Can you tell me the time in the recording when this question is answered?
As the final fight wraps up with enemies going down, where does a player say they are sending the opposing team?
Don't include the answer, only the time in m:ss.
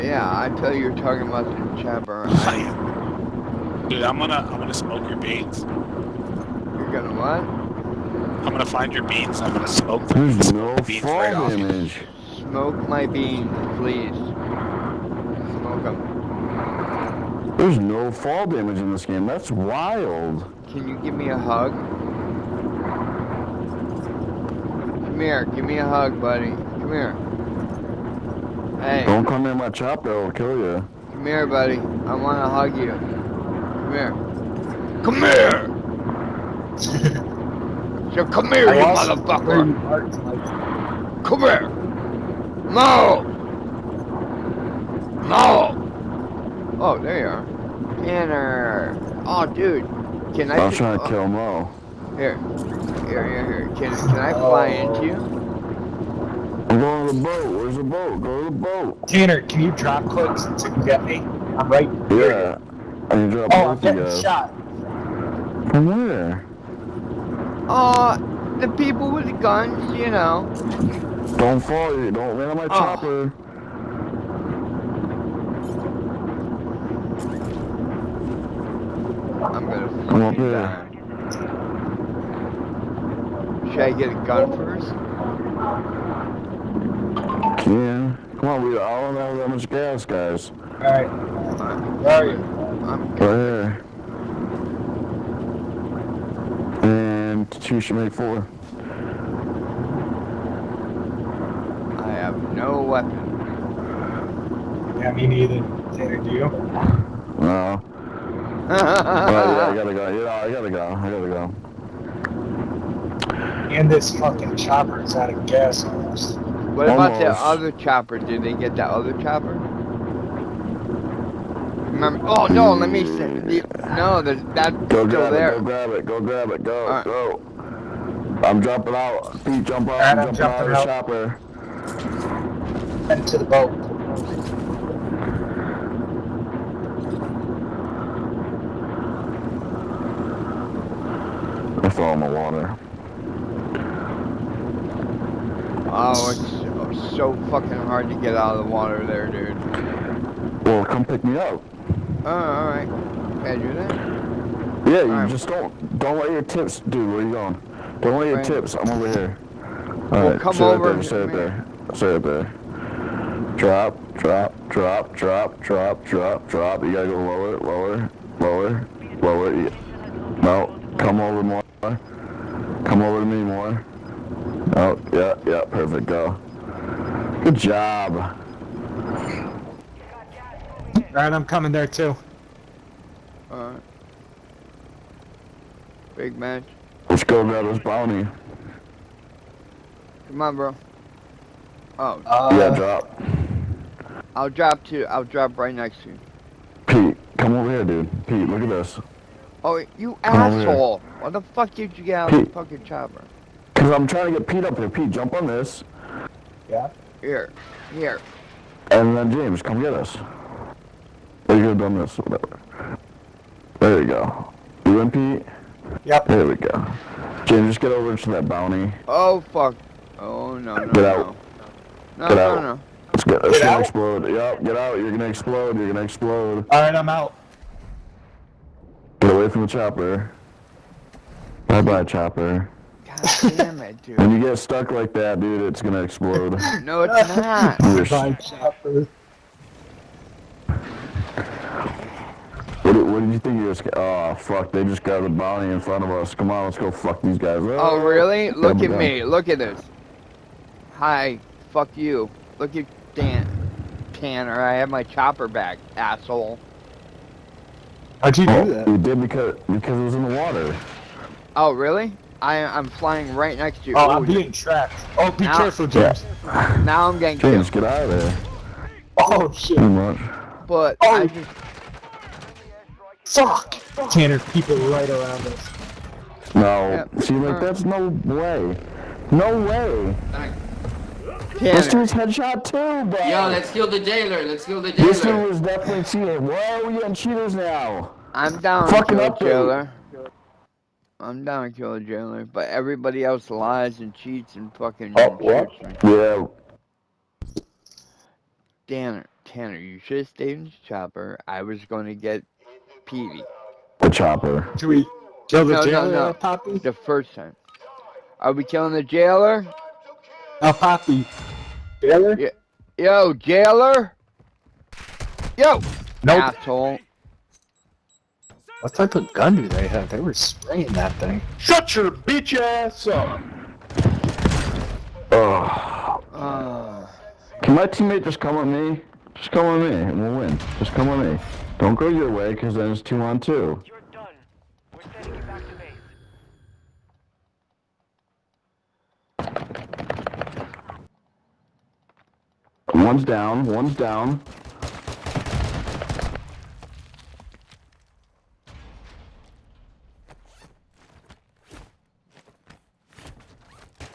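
5:35.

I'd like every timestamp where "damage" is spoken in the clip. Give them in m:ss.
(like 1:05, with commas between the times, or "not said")
0:11, 0:18.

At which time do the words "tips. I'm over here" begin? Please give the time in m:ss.
2:38.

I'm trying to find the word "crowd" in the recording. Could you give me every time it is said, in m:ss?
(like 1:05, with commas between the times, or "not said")
not said.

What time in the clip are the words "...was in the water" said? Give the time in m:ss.
4:20.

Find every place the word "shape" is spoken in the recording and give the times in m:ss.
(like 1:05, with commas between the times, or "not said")
not said.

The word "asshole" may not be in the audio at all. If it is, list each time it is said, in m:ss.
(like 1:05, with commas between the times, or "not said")
3:20, 4:15, 5:16.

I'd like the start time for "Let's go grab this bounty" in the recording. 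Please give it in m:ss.
3:07.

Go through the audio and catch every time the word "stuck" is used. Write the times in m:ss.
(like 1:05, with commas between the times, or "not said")
3:54.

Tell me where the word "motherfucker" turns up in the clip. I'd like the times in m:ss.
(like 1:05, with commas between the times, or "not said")
0:38.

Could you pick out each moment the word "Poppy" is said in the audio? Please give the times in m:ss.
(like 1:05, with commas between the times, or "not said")
5:06, 5:10.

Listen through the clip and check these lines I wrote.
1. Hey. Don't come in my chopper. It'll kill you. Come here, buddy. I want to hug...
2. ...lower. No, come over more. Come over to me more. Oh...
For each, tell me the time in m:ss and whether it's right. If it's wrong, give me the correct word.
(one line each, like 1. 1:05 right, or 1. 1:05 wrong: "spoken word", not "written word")
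1. 0:28 right
2. 2:49 right.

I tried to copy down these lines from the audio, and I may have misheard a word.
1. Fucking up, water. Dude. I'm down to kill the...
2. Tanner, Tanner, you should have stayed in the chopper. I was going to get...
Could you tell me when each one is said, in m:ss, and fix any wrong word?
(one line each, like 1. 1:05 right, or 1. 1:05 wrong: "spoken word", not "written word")
1. 4:48 wrong: "jailer", not "water"
2. 4:58 right.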